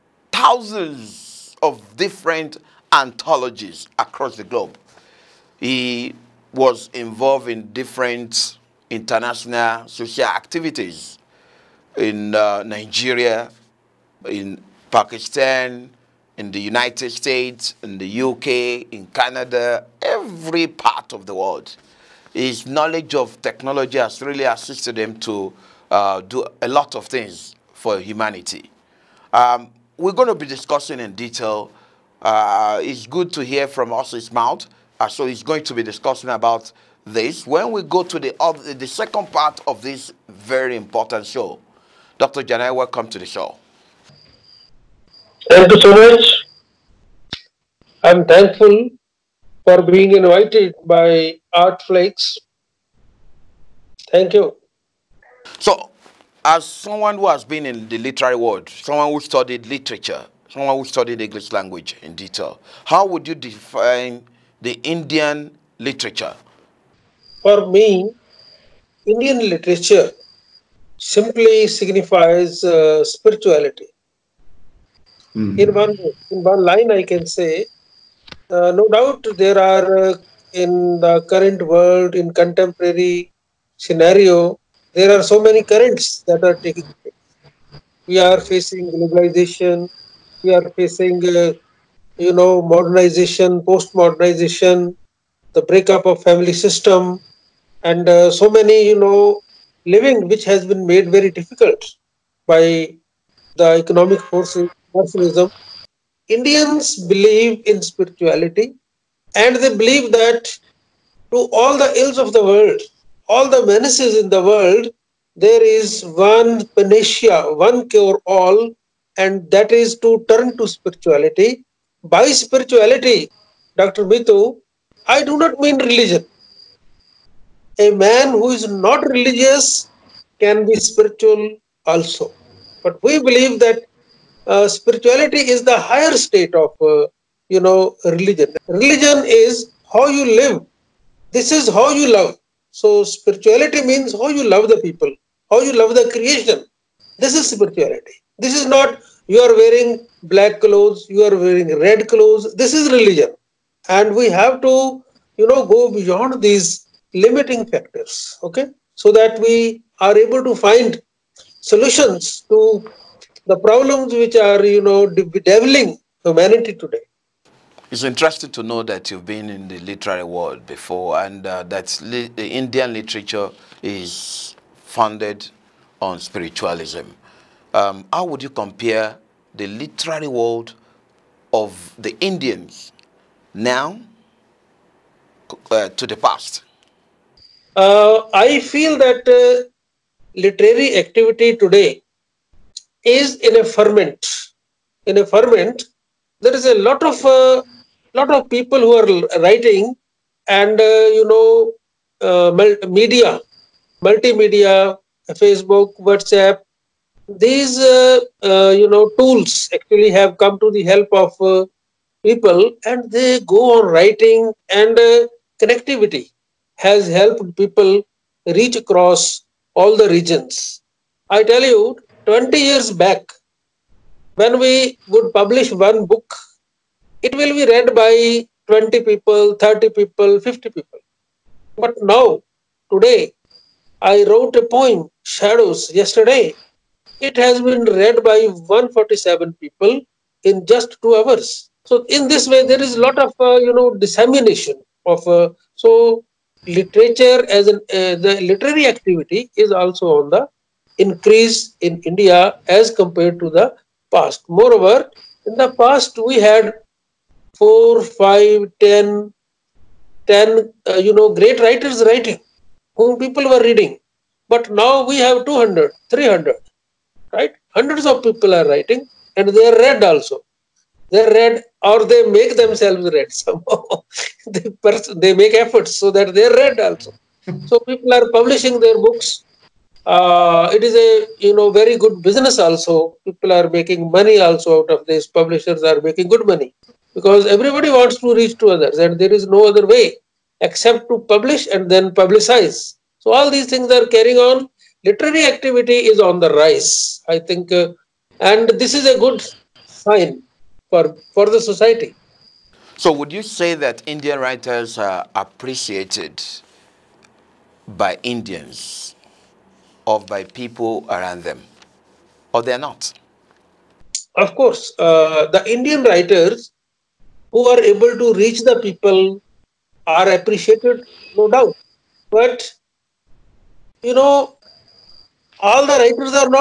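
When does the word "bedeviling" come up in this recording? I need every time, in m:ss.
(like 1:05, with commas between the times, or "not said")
2:45.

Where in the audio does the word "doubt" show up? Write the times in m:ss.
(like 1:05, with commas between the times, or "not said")
1:18, 5:21.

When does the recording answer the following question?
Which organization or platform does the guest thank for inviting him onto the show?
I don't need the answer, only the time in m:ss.
0:51.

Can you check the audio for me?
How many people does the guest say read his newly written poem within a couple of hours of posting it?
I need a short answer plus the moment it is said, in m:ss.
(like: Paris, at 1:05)
147, at 3:58.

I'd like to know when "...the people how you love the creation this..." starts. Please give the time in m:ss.
2:24.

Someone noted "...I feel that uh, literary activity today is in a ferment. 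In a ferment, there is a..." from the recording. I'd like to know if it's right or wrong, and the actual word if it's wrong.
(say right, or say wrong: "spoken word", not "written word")
right.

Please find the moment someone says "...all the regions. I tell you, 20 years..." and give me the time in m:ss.
3:39.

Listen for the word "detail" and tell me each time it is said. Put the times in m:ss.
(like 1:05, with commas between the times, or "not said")
0:31, 1:02.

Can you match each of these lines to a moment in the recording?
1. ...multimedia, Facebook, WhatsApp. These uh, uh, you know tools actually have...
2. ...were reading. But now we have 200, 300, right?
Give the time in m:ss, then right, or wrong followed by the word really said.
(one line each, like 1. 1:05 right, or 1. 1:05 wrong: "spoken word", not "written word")
1. 3:24 right
2. 4:23 right.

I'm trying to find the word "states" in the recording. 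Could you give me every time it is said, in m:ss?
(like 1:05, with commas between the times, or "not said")
0:17, 2:16.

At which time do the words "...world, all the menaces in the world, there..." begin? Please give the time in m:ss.
1:52.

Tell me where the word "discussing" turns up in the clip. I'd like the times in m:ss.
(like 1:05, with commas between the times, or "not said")
0:30, 0:35.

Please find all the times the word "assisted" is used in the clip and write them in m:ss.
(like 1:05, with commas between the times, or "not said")
0:24.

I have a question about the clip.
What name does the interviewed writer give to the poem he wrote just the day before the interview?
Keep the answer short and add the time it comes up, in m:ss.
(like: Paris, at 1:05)
Shadows, at 3:55.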